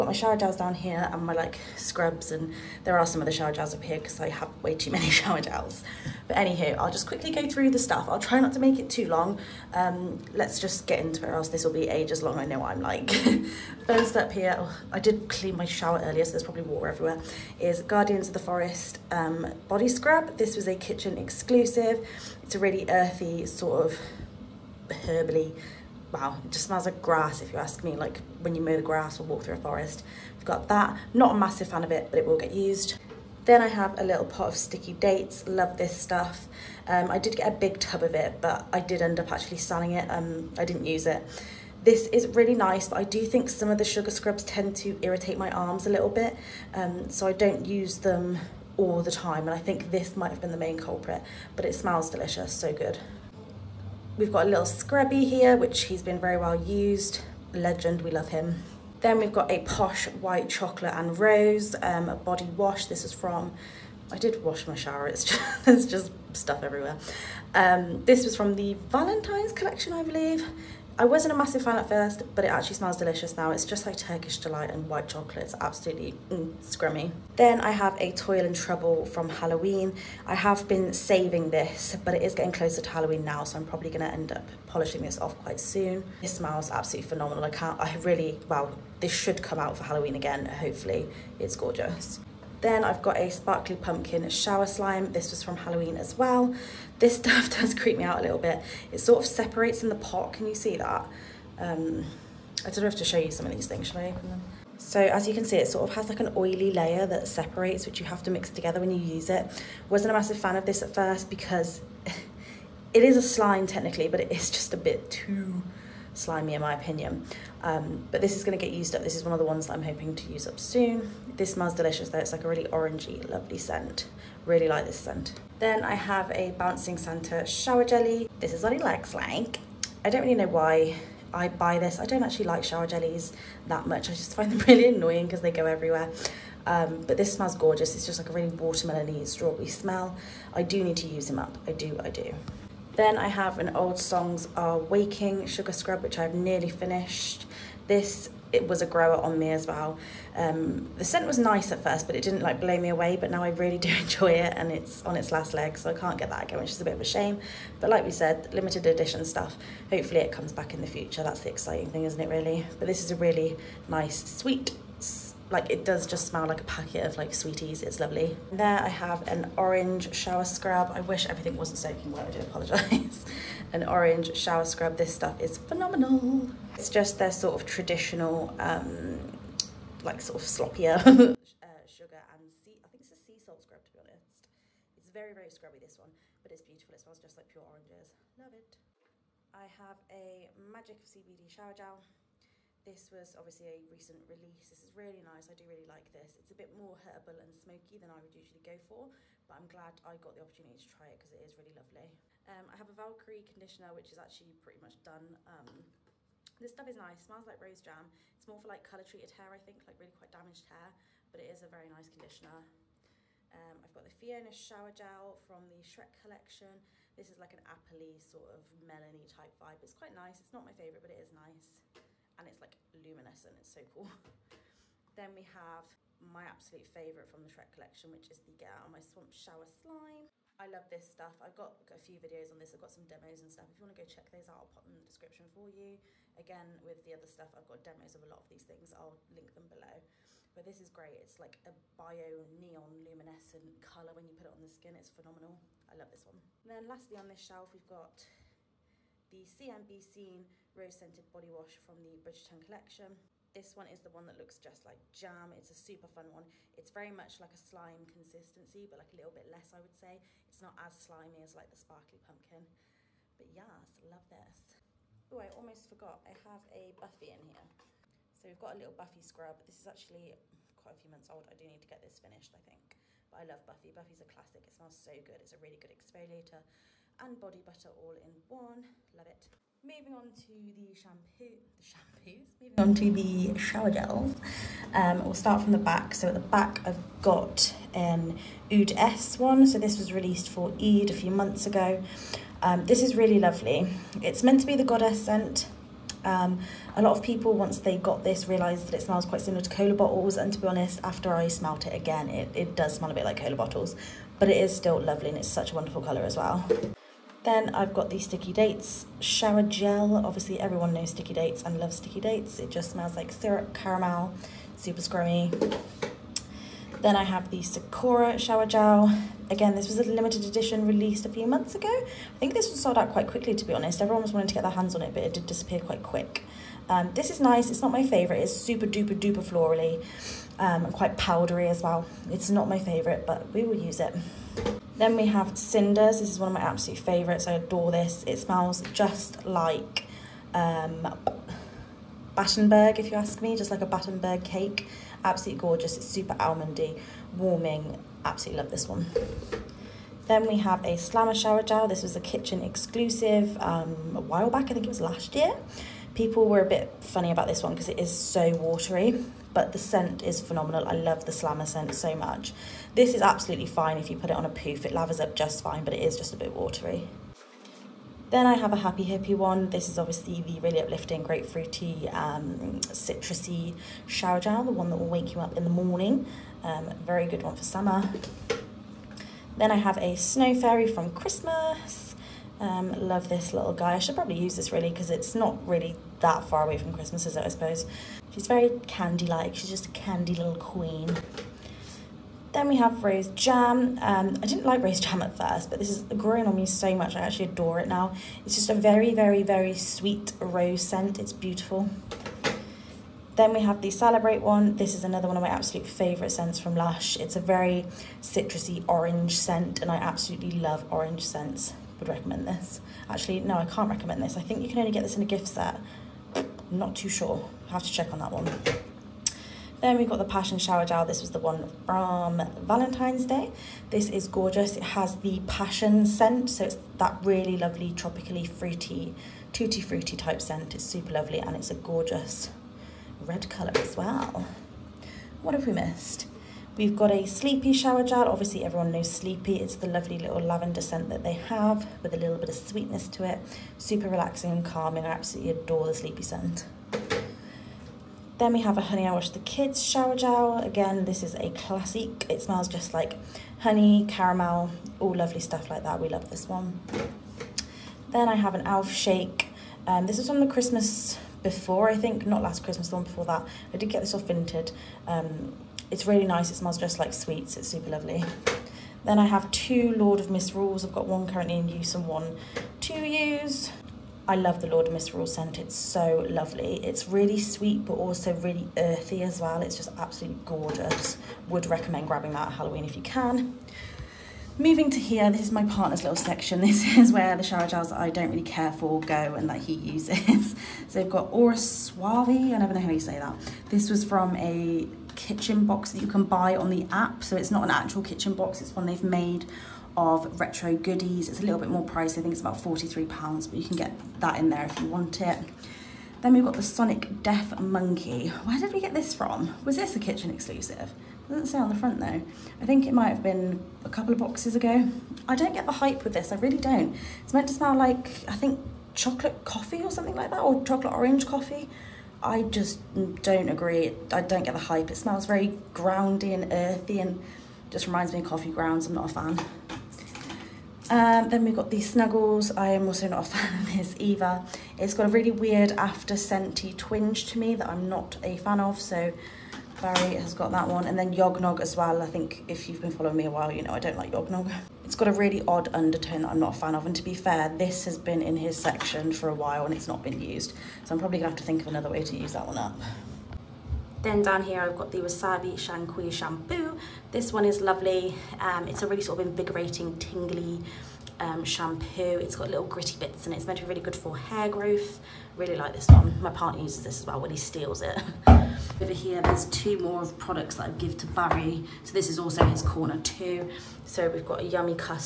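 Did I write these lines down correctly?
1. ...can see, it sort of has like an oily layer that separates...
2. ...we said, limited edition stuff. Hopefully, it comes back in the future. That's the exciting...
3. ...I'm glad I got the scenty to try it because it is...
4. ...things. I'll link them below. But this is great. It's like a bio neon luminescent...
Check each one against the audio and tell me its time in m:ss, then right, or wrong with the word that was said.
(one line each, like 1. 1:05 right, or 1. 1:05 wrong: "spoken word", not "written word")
1. 1:45 right
2. 2:38 right
3. 3:19 wrong: "opportunity", not "scenty"
4. 3:58 right.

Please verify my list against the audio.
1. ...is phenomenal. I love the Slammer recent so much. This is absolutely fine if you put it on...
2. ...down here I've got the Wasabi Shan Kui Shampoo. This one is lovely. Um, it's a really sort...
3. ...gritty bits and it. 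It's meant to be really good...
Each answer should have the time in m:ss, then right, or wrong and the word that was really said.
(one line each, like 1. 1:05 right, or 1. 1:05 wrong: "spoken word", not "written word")
1. 6:00 wrong: "scent", not "recent"
2. 9:14 right
3. 9:22 right.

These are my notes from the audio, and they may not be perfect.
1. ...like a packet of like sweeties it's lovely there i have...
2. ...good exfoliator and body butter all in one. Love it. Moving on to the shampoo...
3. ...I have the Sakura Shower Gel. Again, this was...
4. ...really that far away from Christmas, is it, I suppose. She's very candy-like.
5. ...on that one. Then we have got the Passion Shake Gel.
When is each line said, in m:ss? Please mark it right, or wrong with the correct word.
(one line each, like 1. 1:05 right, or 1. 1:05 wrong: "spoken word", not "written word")
1. 2:46 right
2. 4:35 right
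3. 5:17 right
4. 6:25 right
5. 6:58 wrong: "Shower", not "Shake".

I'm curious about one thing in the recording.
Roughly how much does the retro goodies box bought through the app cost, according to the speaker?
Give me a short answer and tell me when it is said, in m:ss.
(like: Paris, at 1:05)
£43, at 8:22.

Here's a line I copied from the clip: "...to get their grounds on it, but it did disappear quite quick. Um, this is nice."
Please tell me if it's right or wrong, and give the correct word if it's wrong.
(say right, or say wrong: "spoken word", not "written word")
wrong: "hands", not "grounds".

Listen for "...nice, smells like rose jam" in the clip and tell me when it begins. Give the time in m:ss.
3:26.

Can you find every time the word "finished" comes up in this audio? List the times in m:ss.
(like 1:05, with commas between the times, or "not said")
2:26, 4:32.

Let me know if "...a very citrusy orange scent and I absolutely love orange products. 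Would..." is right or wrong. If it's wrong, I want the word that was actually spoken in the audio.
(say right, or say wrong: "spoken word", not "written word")
wrong: "scents", not "products".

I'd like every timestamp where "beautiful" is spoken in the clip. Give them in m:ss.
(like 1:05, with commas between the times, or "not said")
3:06, 6:41.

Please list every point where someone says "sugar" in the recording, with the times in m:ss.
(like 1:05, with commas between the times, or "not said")
0:43, 2:25, 3:01.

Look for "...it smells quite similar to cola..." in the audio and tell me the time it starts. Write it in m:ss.
4:58.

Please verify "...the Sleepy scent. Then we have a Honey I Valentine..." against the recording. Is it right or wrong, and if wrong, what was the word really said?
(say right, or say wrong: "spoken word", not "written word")
wrong: "Wash", not "Valentine".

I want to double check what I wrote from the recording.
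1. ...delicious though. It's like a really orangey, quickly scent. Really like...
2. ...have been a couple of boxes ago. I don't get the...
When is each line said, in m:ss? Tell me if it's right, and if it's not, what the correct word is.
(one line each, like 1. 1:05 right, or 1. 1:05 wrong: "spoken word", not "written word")
1. 2:01 wrong: "lovely", not "quickly"
2. 8:33 right.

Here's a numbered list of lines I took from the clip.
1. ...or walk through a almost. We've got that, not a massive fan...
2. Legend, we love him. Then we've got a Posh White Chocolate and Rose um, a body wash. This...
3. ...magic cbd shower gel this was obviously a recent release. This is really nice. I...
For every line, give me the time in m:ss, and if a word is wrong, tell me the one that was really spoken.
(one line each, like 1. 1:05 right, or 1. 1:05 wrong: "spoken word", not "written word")
1. 0:29 wrong: "forest", not "almost"
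2. 0:57 right
3. 3:10 right.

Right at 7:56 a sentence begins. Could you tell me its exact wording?
It's really sweet, but also really earthy as well.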